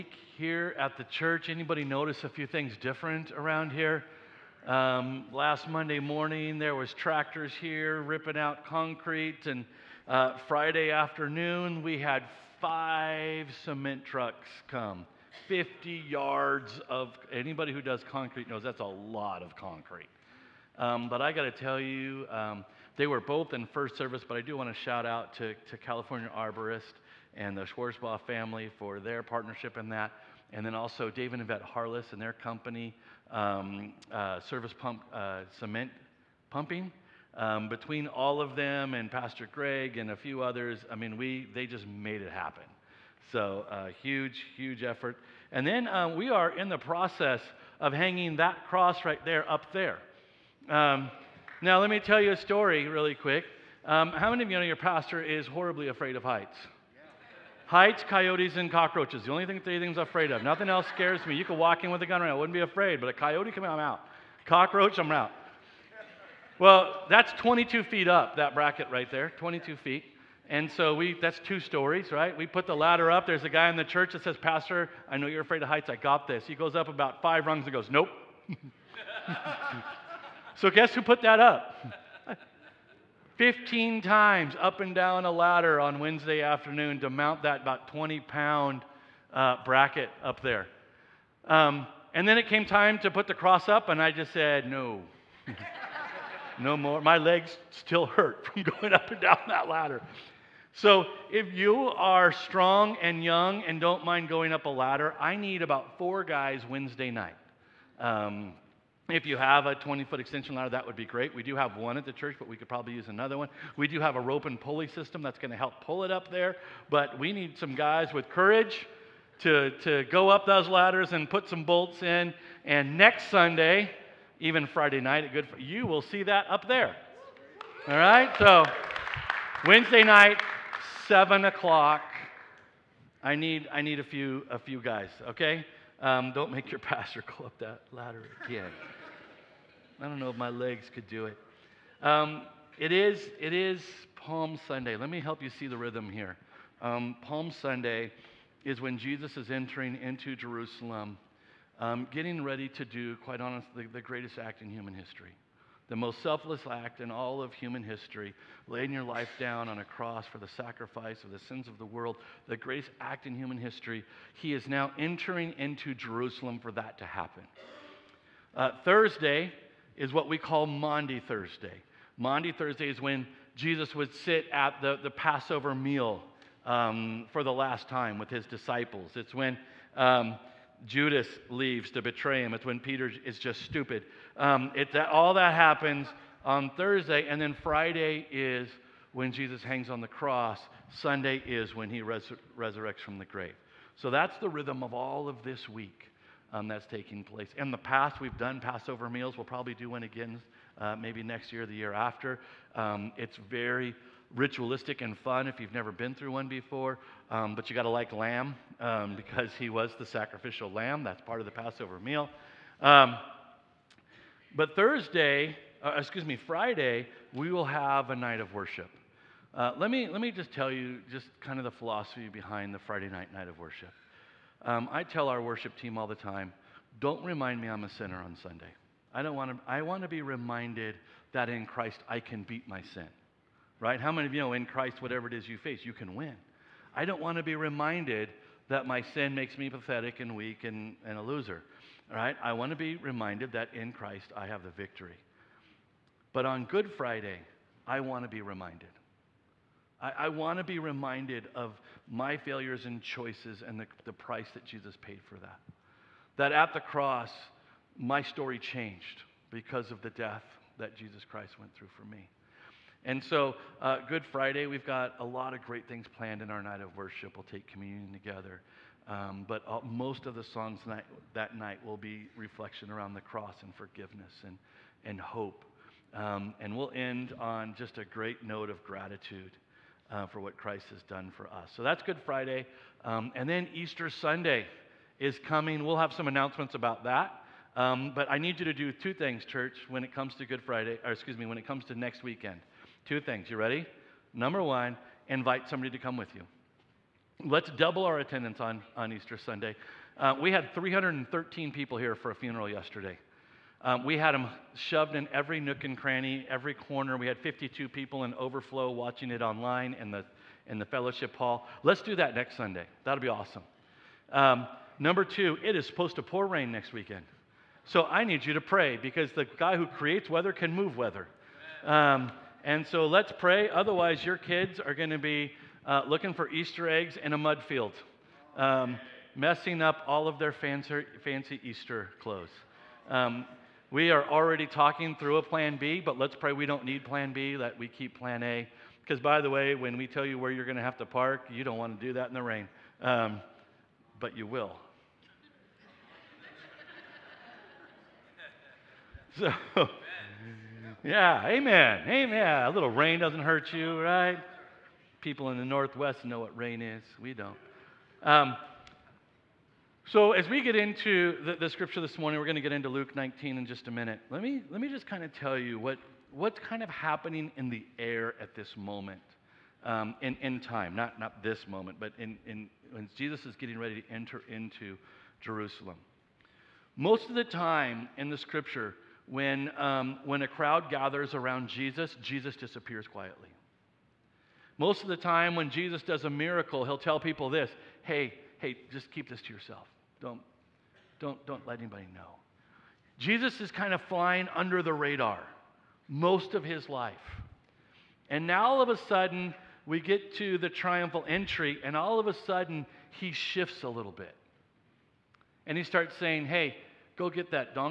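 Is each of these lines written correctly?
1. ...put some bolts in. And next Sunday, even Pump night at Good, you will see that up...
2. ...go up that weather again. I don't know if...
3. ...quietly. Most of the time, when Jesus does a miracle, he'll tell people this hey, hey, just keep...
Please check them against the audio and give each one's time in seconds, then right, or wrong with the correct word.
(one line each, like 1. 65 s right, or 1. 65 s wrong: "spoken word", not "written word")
1. 121 s wrong: "Friday", not "Pump"
2. 137 s wrong: "ladder", not "weather"
3. 383 s right.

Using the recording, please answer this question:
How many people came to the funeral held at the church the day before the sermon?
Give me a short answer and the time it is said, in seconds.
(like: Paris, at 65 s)
313, at 300 s.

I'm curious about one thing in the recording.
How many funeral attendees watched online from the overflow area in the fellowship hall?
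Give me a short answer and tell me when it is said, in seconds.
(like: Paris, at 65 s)
52, at 307 s.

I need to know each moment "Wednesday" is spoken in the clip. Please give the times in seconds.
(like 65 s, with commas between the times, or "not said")
85 s, 106 s, 129 s.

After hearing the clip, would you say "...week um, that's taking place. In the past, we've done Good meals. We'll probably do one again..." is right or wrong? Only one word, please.
wrong.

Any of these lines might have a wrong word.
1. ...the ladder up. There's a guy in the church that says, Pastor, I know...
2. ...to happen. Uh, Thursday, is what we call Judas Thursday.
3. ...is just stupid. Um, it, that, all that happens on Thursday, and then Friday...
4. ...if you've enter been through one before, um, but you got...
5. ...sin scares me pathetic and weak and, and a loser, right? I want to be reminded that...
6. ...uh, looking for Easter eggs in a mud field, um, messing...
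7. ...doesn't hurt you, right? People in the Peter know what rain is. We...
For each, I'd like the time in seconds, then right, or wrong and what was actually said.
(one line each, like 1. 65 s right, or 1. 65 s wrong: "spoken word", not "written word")
1. 72 s right
2. 166 s wrong: "Maundy", not "Judas"
3. 183 s right
4. 205 s wrong: "never", not "enter"
5. 239 s wrong: "makes", not "scares"
6. 325 s right
7. 353 s wrong: "Northwest", not "Peter".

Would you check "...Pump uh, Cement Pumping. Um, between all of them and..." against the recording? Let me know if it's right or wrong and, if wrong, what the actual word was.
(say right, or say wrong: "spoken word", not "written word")
right.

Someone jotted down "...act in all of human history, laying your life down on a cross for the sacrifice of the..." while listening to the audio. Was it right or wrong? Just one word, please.
right.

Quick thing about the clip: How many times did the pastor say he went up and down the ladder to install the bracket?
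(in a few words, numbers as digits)
15.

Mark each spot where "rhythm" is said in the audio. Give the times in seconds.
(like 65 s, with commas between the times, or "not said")
145 s, 194 s.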